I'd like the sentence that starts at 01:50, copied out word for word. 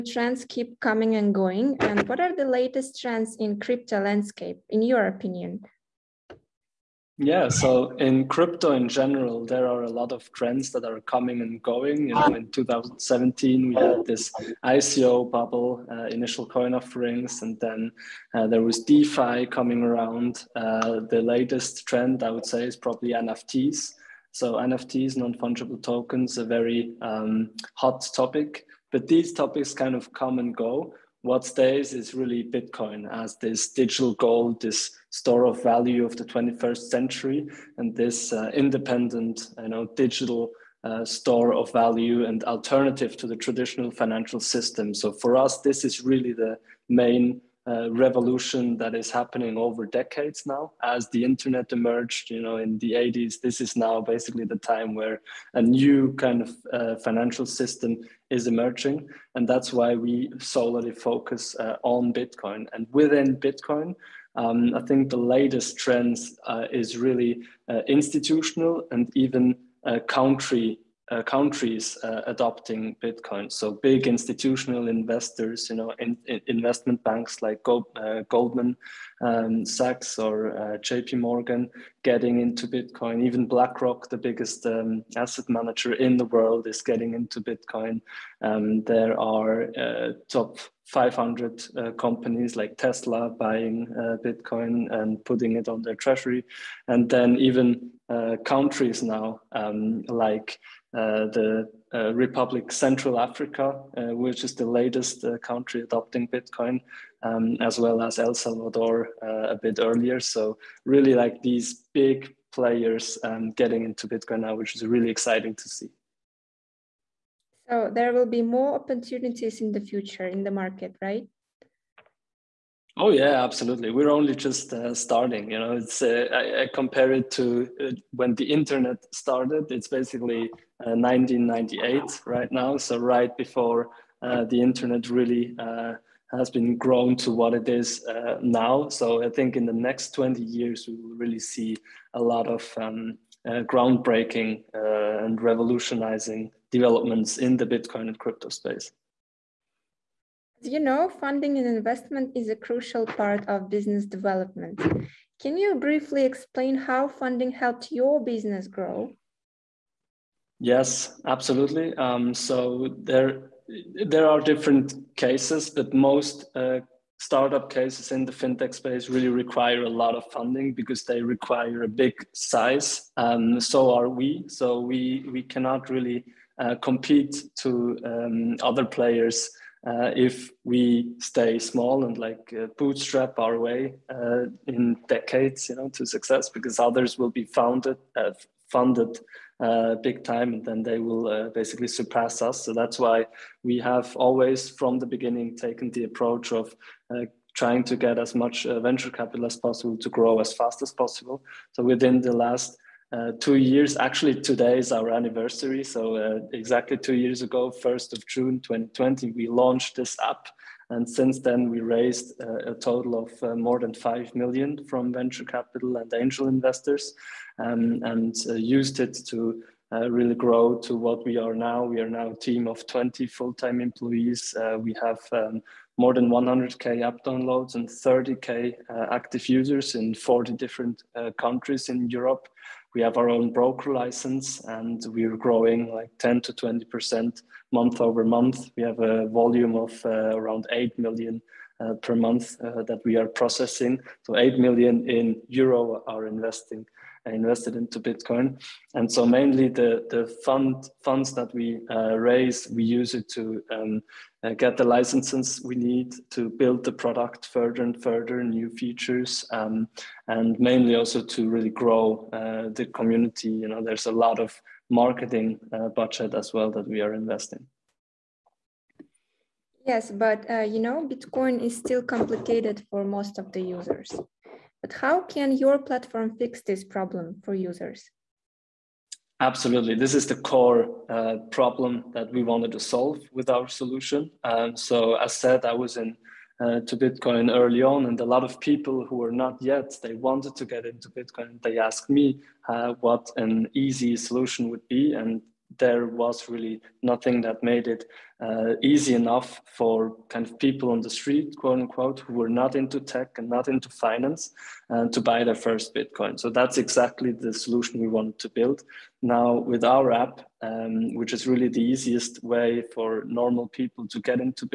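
So really like these big players um, getting into Bitcoin now, which is really exciting to see.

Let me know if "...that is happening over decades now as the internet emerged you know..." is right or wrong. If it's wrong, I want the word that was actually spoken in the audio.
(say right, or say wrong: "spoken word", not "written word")
right.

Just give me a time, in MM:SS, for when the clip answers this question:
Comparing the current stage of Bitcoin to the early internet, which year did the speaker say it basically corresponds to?
02:10.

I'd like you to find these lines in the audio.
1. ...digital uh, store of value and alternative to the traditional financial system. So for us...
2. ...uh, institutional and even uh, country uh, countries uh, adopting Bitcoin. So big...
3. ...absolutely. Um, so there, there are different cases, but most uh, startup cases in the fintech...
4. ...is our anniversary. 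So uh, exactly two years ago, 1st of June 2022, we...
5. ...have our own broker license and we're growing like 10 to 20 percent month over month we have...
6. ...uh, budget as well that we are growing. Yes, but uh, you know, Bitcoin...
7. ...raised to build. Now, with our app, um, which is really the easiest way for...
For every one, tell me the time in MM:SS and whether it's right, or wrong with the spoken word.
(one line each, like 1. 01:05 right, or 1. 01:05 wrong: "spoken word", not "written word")
1. 00:39 right
2. 01:07 right
3. 02:41 right
4. 03:24 wrong: "2020", not "2022"
5. 03:53 right
6. 04:25 wrong: "investing", not "growing"
7. 05:08 wrong: "wanted", not "raised".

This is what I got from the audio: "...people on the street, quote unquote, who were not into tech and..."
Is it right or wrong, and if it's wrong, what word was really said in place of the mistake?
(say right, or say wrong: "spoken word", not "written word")
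right.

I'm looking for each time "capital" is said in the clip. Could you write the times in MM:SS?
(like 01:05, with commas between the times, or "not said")
03:19, 03:35.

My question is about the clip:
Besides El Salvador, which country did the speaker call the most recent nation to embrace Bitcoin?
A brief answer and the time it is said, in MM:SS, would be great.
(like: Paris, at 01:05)
Republic Central Africa, at 01:42.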